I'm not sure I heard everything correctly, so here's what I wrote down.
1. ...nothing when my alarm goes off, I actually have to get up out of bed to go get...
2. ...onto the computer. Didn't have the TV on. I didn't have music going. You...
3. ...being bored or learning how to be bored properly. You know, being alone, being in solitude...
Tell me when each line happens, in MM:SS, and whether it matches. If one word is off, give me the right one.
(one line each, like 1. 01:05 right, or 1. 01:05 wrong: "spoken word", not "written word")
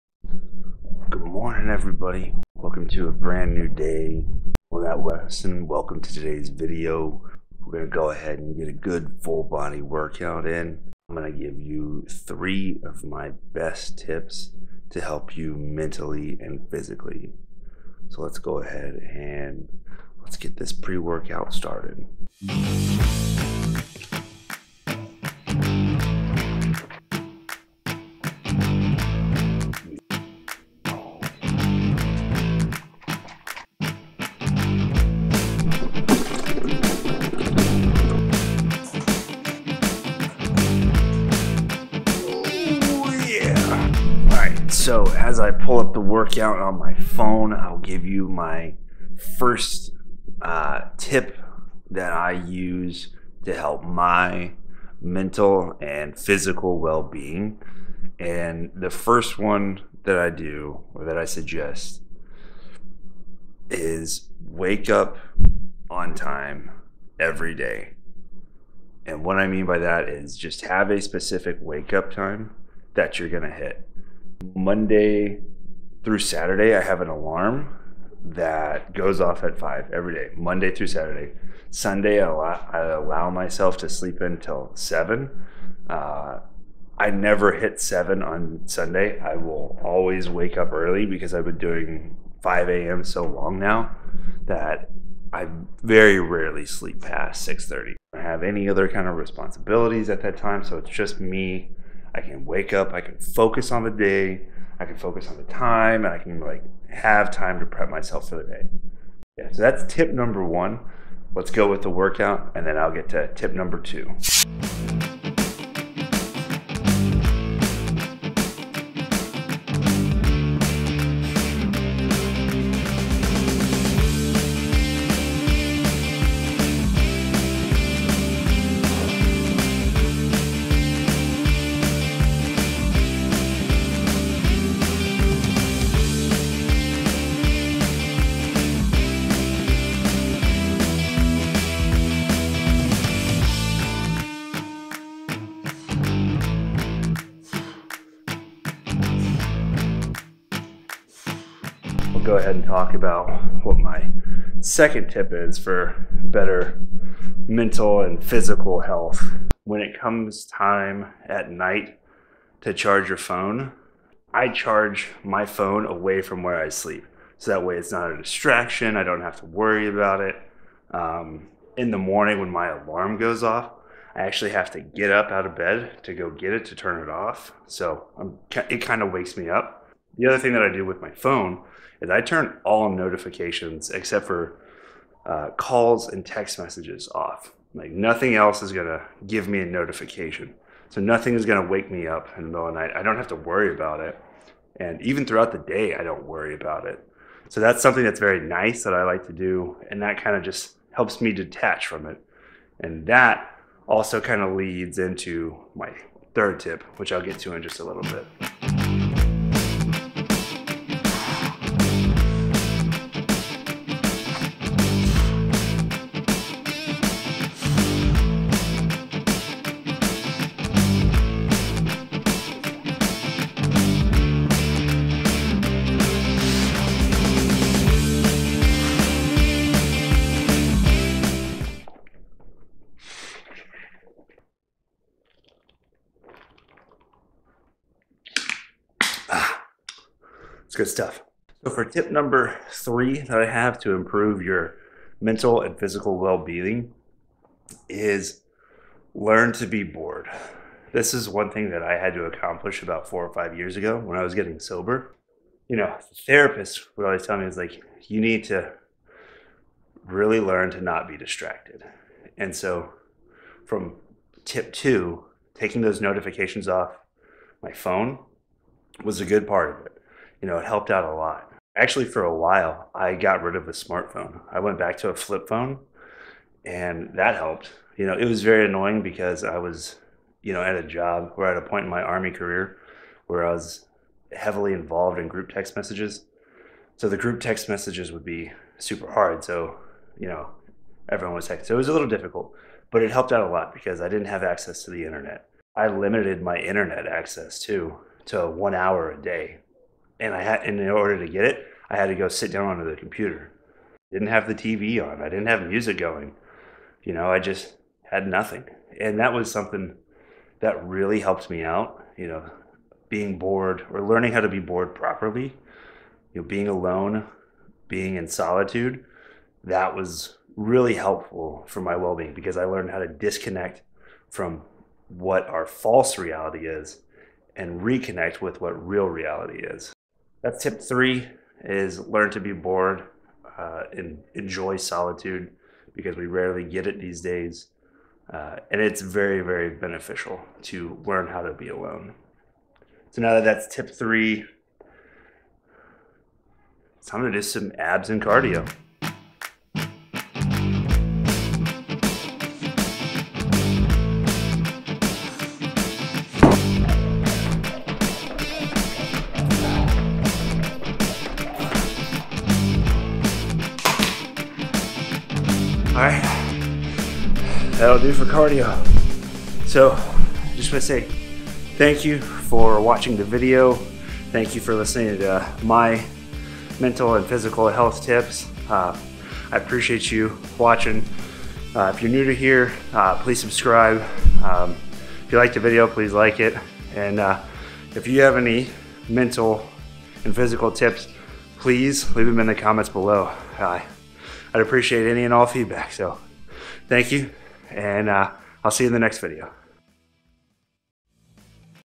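1. 02:51 wrong: "morning", not "nothing"
2. 05:02 right
3. 05:13 right.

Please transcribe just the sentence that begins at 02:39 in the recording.
When it comes time at night to charge your phone, I charge my phone away from where I sleep.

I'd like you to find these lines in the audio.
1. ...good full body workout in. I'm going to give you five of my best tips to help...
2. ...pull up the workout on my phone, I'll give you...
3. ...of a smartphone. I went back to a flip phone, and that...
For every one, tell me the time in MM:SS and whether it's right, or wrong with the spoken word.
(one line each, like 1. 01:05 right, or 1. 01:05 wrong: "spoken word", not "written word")
1. 00:08 wrong: "three", not "five"
2. 00:45 right
3. 04:33 right.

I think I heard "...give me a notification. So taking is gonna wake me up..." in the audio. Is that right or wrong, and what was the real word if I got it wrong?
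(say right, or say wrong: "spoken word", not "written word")
wrong: "nothing", not "taking".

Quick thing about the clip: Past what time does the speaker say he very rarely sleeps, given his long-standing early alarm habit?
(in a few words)
6:30.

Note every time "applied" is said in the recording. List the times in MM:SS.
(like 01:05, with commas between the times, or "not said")
not said.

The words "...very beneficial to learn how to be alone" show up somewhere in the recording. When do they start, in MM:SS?
05:39.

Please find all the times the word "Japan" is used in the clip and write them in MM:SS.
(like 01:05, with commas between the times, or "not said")
not said.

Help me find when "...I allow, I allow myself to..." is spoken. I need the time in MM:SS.
01:22.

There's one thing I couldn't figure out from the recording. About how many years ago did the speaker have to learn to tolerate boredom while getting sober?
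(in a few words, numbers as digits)
4 or 5 years.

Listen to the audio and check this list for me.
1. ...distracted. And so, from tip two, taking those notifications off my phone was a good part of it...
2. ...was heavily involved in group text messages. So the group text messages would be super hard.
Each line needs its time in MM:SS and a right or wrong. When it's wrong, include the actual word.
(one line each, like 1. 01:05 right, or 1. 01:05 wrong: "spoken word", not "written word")
1. 04:21 right
2. 04:43 right.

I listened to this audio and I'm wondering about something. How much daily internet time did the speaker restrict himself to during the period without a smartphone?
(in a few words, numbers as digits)
1 hour.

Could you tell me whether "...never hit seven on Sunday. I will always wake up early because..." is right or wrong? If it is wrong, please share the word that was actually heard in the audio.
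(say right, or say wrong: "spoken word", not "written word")
right.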